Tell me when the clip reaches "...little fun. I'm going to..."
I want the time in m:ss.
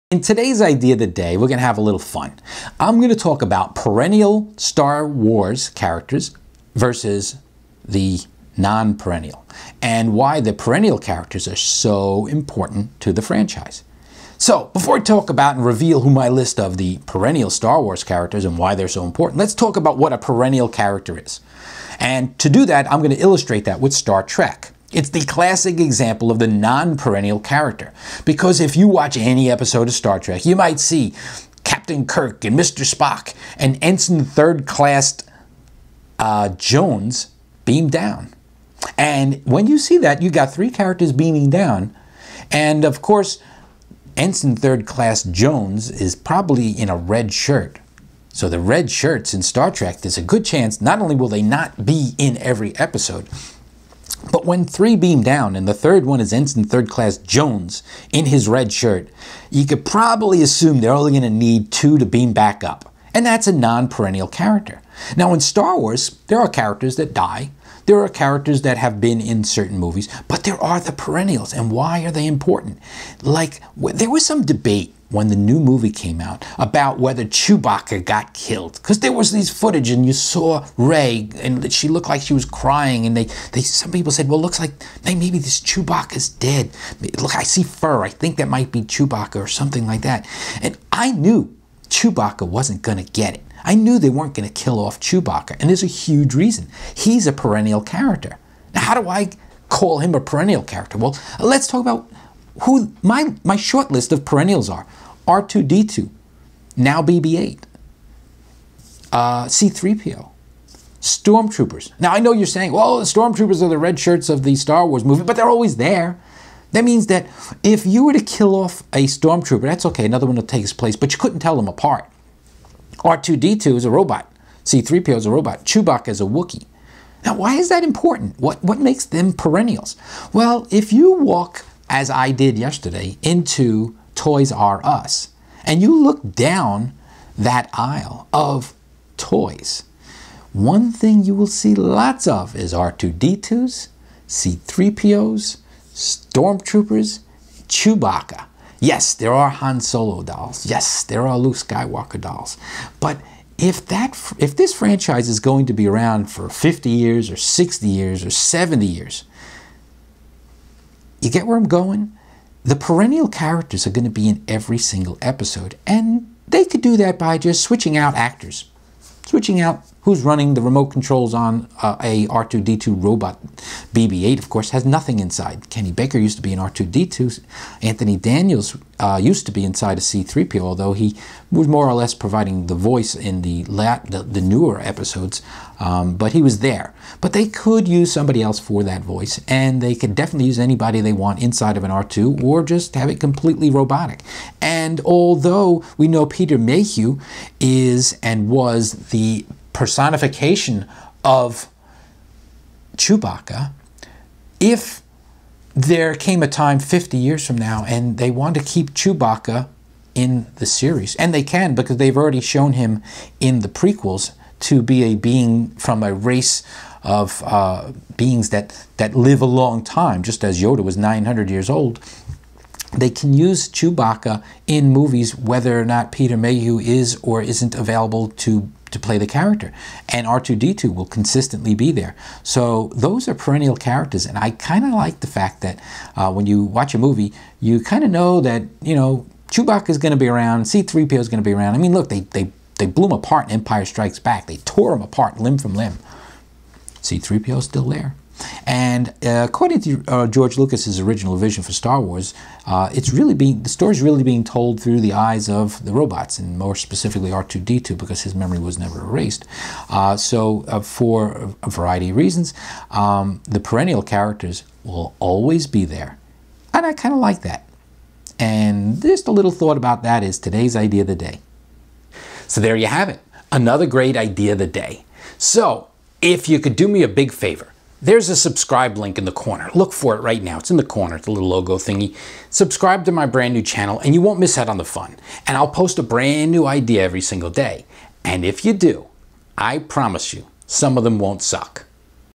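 0:01.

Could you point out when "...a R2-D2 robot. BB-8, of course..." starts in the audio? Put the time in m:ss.
2:52.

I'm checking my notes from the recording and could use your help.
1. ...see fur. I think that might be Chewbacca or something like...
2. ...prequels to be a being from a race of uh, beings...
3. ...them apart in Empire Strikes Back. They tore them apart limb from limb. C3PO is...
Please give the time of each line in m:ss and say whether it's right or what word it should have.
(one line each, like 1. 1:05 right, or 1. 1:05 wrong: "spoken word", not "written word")
1. 1:27 right
2. 3:33 right
3. 4:03 right.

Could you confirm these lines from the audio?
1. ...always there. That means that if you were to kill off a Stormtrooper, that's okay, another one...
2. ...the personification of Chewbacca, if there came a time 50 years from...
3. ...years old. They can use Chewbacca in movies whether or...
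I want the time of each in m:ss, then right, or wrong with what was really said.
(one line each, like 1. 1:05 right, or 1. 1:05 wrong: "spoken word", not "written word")
1. 1:55 right
2. 3:19 right
3. 3:41 right.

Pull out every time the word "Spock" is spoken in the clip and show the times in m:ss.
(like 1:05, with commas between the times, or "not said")
0:32.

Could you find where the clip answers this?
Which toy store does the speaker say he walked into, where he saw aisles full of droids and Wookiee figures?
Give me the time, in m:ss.
2:14.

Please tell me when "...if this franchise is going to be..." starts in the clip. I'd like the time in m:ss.
2:34.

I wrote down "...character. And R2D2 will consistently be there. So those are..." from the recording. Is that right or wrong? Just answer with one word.
right.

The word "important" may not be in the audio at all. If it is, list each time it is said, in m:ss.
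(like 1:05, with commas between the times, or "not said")
0:12, 0:19, 1:12, 2:07.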